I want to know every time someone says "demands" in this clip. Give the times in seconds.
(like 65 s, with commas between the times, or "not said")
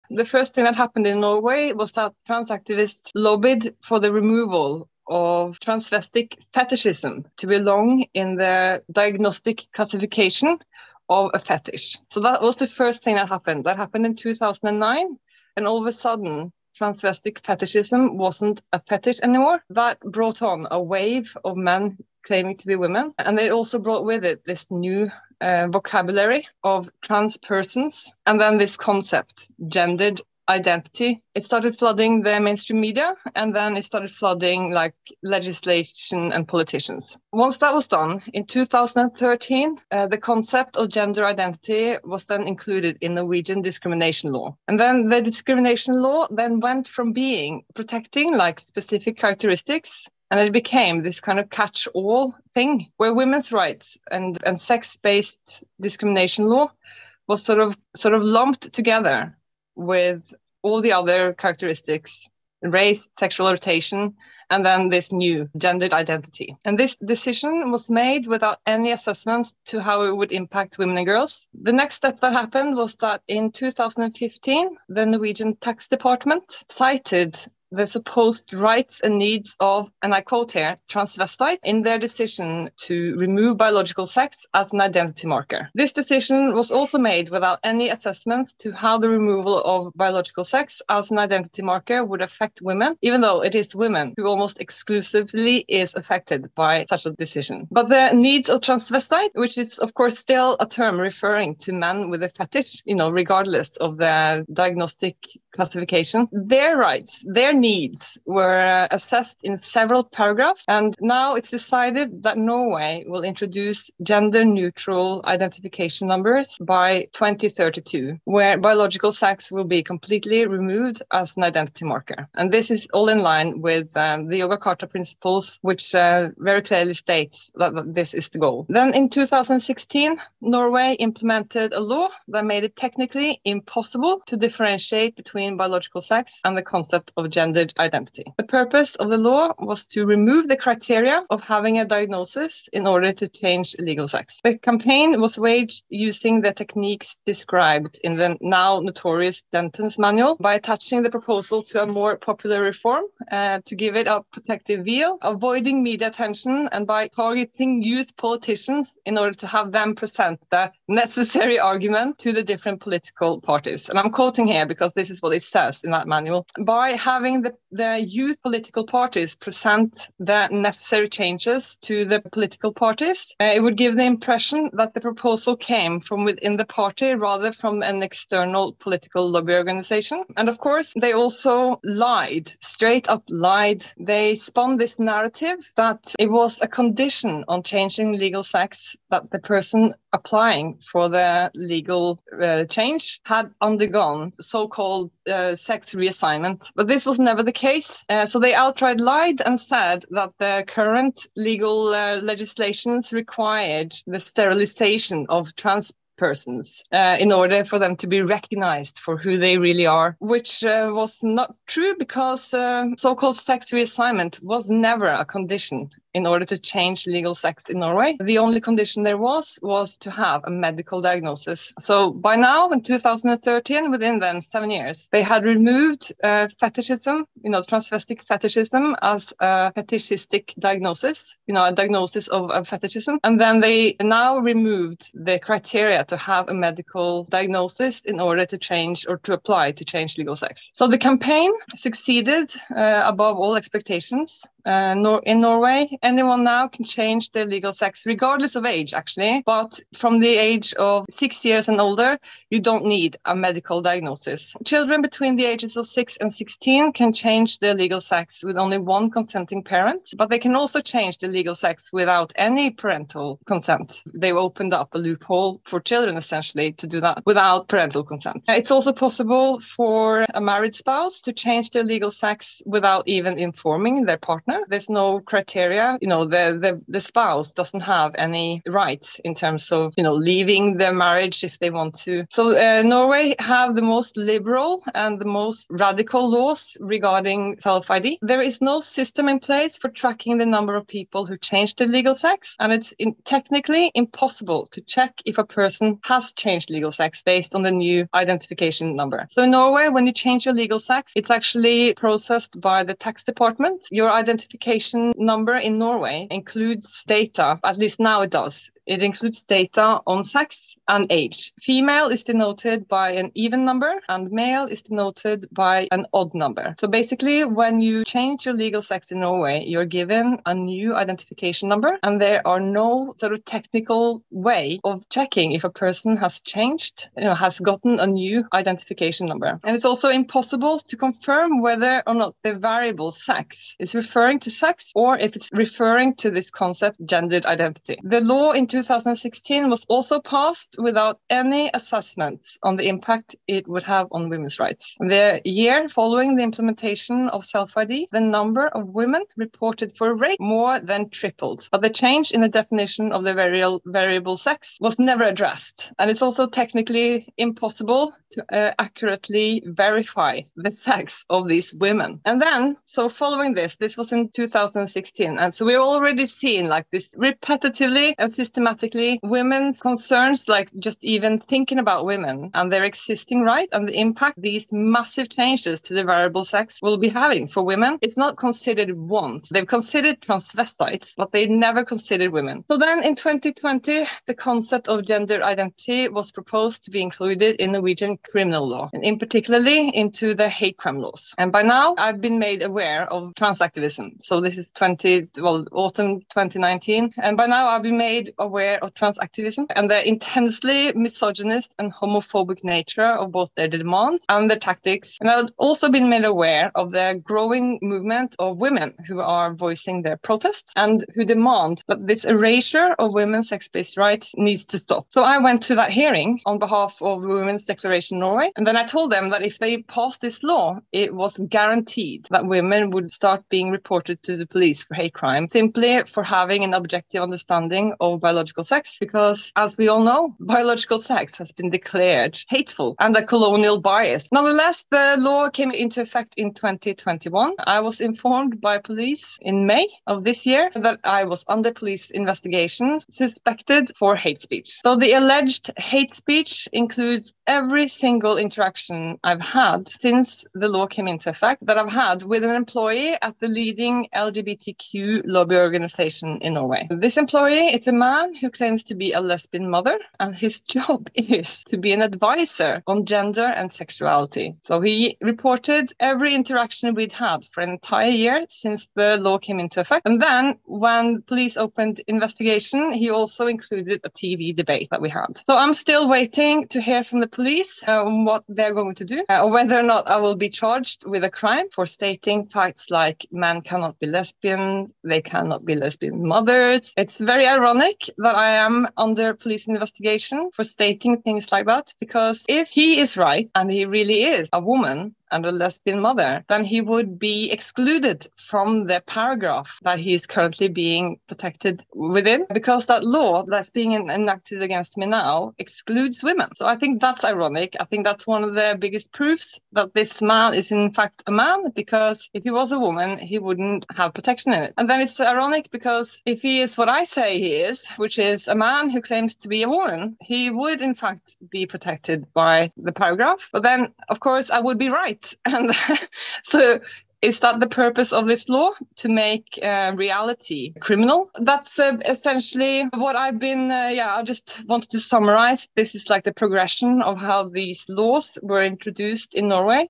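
403 s, 411 s.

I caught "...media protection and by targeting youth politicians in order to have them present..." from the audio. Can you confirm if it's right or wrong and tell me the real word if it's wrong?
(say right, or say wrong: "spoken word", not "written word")
wrong: "attention", not "protection".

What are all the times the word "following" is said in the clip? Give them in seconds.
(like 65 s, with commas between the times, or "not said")
345 s, 363 s.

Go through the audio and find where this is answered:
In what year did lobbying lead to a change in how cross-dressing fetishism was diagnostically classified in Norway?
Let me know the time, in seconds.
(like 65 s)
14 s.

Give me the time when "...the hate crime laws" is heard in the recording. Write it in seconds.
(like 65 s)
390 s.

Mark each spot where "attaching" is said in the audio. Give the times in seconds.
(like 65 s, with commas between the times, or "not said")
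150 s.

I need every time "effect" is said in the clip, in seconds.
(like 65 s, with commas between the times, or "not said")
436 s, 451 s, 469 s.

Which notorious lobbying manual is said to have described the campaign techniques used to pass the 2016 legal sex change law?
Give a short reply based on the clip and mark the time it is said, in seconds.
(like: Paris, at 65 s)
Dentons manual, at 149 s.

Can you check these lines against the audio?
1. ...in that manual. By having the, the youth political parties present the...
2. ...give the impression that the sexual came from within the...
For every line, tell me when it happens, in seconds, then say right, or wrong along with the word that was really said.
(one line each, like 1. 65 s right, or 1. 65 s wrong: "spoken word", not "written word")
1. 165 s right
2. 173 s wrong: "proposal", not "sexual".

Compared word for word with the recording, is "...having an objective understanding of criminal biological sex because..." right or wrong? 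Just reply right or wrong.
wrong.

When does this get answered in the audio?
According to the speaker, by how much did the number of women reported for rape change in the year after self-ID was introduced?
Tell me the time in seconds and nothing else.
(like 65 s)
350 s.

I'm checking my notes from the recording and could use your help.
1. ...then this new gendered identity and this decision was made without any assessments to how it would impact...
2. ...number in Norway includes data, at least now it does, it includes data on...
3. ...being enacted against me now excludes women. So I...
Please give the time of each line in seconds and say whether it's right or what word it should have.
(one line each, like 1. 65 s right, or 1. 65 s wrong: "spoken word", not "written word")
1. 64 s right
2. 305 s right
3. 503 s right.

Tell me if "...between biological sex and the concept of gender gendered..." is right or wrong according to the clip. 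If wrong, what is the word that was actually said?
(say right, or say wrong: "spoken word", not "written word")
right.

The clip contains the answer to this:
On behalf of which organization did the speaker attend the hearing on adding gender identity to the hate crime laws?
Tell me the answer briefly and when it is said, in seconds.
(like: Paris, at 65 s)
Women's Declaration Norway, at 417 s.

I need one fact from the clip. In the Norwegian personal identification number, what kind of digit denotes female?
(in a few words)
Even number.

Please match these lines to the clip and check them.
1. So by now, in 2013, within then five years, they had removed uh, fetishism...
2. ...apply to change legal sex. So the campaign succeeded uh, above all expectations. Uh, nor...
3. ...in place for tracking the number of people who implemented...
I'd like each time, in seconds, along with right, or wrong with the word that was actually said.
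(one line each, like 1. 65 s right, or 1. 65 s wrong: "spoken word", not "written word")
1. 221 s wrong: "seven", not "five"
2. 239 s right
3. 289 s wrong: "changed", not "implemented".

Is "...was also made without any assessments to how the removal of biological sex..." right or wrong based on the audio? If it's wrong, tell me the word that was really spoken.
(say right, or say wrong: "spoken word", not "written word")
right.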